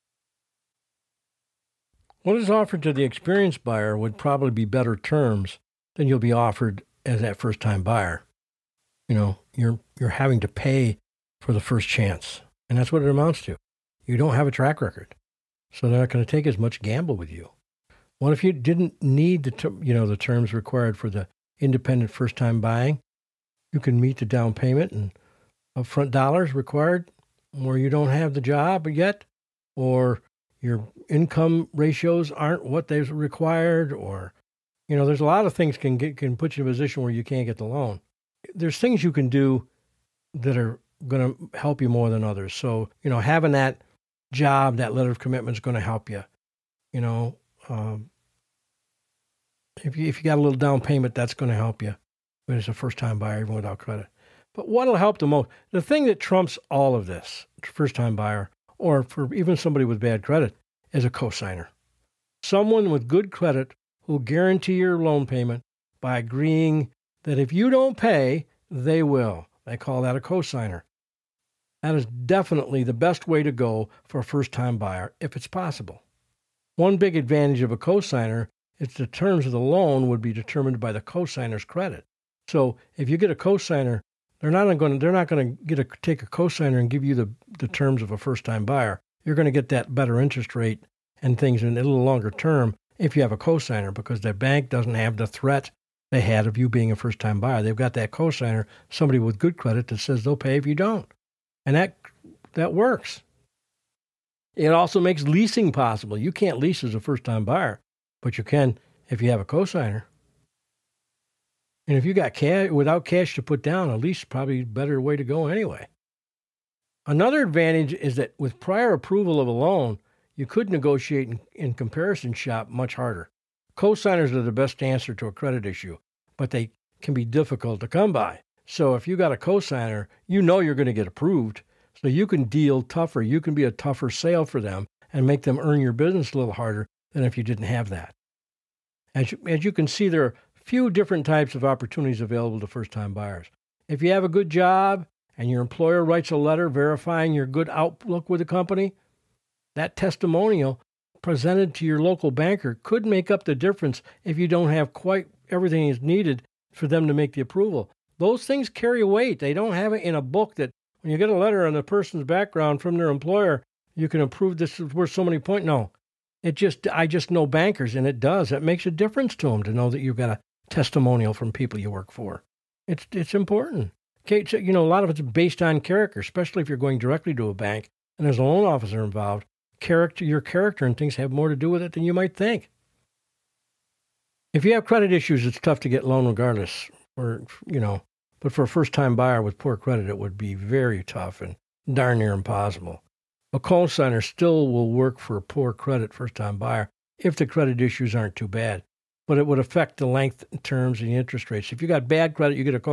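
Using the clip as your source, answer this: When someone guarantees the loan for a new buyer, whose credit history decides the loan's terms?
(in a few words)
The cosigner's credit.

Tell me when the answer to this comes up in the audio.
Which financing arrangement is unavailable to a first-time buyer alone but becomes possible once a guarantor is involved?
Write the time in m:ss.
1:45.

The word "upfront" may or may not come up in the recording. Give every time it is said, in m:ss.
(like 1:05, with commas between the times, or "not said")
0:25.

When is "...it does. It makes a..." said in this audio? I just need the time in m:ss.
2:48.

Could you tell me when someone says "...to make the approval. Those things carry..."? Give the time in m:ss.
2:37.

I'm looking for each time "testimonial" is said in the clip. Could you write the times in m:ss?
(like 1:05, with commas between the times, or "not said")
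2:29, 2:50.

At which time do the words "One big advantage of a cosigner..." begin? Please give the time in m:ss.
1:16.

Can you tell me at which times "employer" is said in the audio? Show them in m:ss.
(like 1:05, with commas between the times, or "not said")
2:25, 2:43.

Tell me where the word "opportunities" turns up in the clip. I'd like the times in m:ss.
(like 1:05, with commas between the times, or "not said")
2:21.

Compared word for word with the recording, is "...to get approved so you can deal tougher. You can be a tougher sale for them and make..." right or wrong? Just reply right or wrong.
right.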